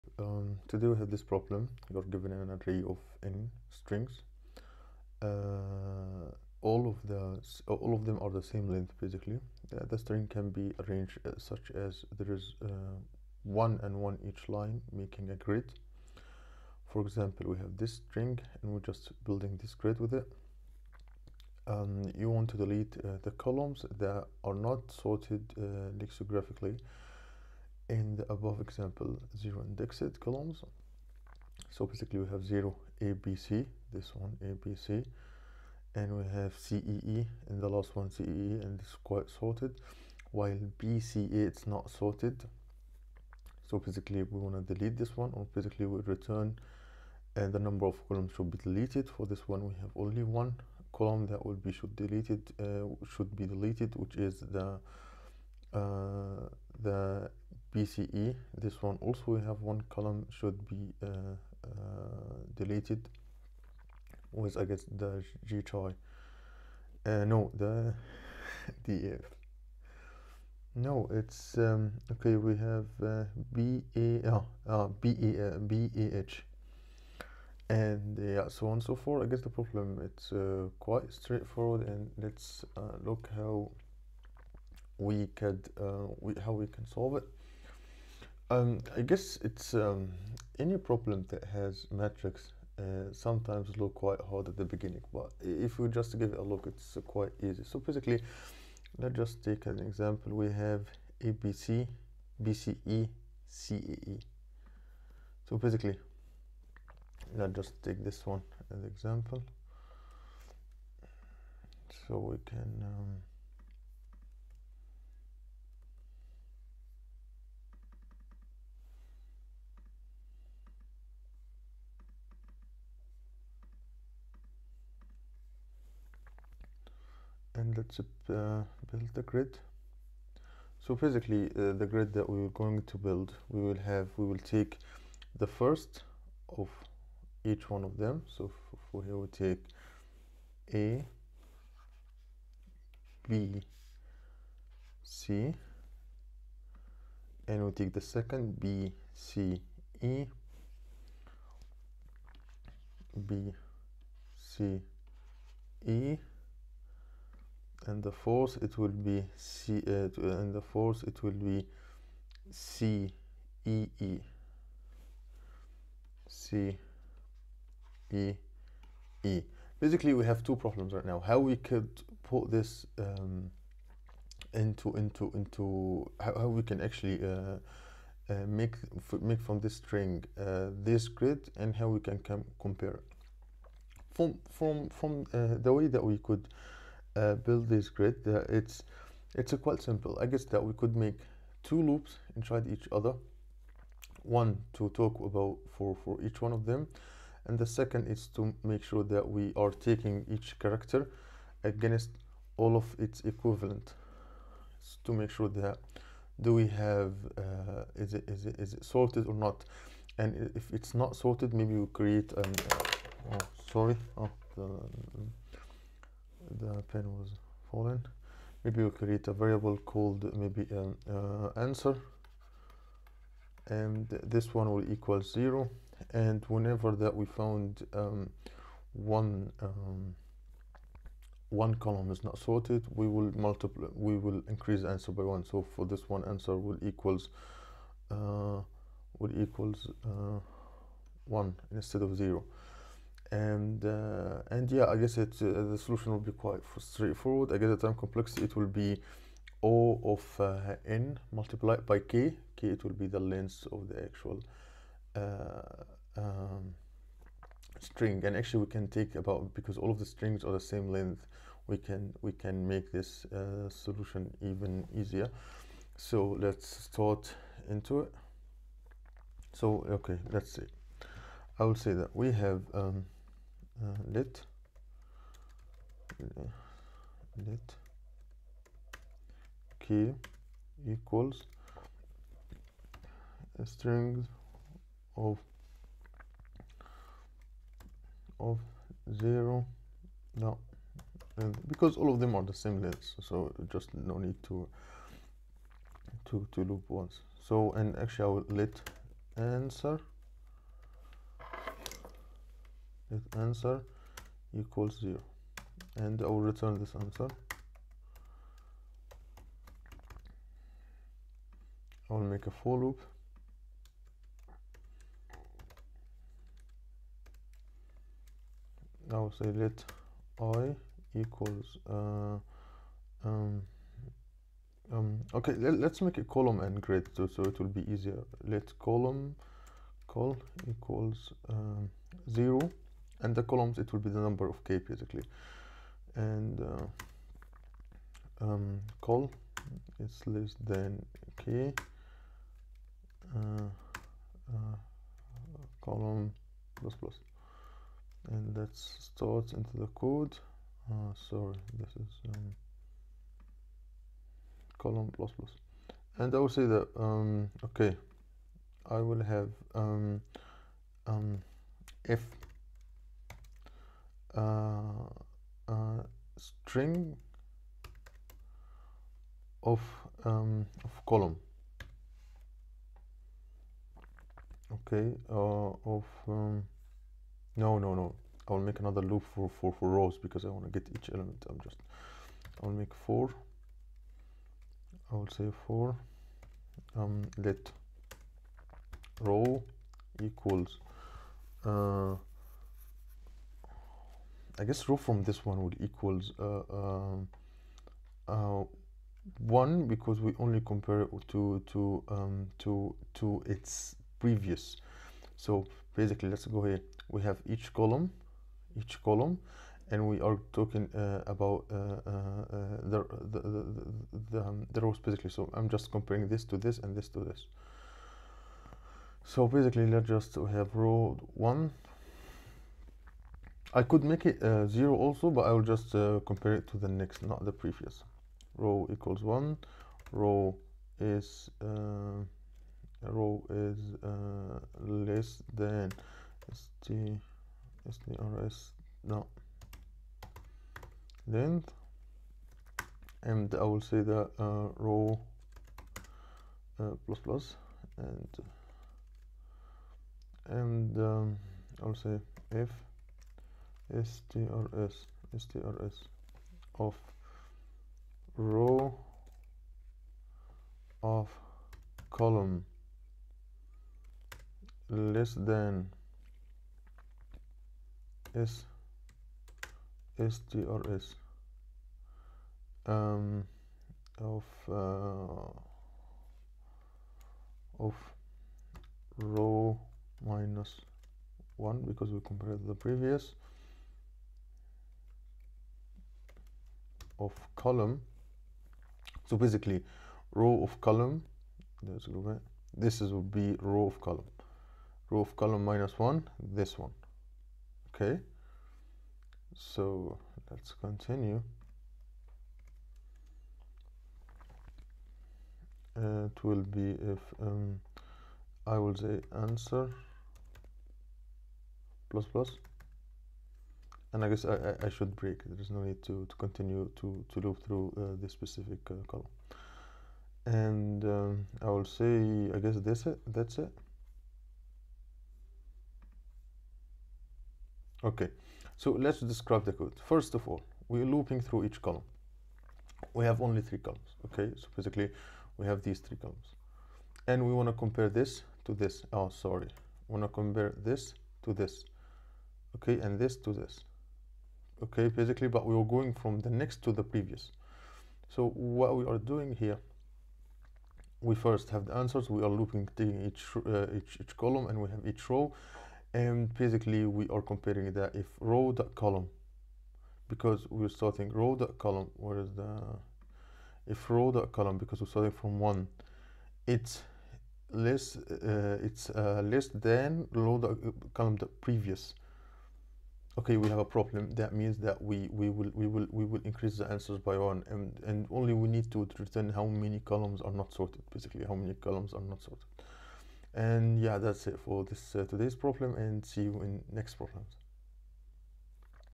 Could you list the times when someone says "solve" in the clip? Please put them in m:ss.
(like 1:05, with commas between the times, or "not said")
1:26.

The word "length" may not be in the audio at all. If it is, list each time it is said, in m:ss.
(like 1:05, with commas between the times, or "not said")
0:08, 4:13, 4:20, 4:52.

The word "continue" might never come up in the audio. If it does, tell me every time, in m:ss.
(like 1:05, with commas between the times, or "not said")
8:20, 8:36.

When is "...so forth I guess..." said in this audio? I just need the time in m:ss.
1:18.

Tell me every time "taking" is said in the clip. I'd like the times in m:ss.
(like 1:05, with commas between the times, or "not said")
3:19, 9:12.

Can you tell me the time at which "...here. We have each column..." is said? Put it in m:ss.
6:46.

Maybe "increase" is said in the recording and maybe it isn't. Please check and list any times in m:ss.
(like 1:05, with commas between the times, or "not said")
3:54, 9:36.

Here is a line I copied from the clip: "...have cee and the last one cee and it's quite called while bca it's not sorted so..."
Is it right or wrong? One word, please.
wrong.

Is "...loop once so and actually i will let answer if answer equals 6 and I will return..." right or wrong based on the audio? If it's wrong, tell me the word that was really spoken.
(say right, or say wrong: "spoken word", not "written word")
wrong: "0", not "6".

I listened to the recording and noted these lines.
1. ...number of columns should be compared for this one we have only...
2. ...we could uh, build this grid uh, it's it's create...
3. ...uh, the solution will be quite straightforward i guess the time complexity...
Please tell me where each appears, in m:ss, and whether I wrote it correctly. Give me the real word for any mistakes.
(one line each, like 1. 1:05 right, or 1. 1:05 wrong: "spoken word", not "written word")
1. 0:47 wrong: "deleted", not "compared"
2. 3:06 wrong: "quite", not "create"
3. 4:05 right.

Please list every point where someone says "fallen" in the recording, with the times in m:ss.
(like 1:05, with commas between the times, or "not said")
3:37.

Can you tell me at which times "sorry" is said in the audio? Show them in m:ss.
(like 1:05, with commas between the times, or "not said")
3:33, 5:51, 8:59.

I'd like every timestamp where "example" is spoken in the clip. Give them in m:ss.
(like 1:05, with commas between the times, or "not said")
0:17, 0:28, 1:39, 1:48.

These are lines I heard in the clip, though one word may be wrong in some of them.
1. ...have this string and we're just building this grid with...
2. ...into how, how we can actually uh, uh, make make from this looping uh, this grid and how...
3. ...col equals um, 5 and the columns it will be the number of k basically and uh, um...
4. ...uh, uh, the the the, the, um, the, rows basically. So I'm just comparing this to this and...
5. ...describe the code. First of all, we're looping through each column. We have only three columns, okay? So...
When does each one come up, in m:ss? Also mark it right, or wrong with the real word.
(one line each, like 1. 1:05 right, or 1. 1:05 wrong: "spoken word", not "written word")
1. 0:17 right
2. 2:55 wrong: "string", not "looping"
3. 5:30 wrong: "0", not "5"
4. 6:51 right
5. 8:49 right.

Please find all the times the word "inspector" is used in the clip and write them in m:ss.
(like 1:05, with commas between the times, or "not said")
not said.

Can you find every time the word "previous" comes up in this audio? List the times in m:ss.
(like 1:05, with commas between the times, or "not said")
6:44, 7:07, 8:02, 9:07, 9:31.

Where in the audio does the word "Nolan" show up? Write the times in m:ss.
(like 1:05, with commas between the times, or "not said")
not said.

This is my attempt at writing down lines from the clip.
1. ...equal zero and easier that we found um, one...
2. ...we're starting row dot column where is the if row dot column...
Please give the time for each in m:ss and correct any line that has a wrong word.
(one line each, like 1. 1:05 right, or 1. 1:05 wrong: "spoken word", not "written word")
1. 3:44 wrong: "whenever", not "easier"
2. 9:20 right.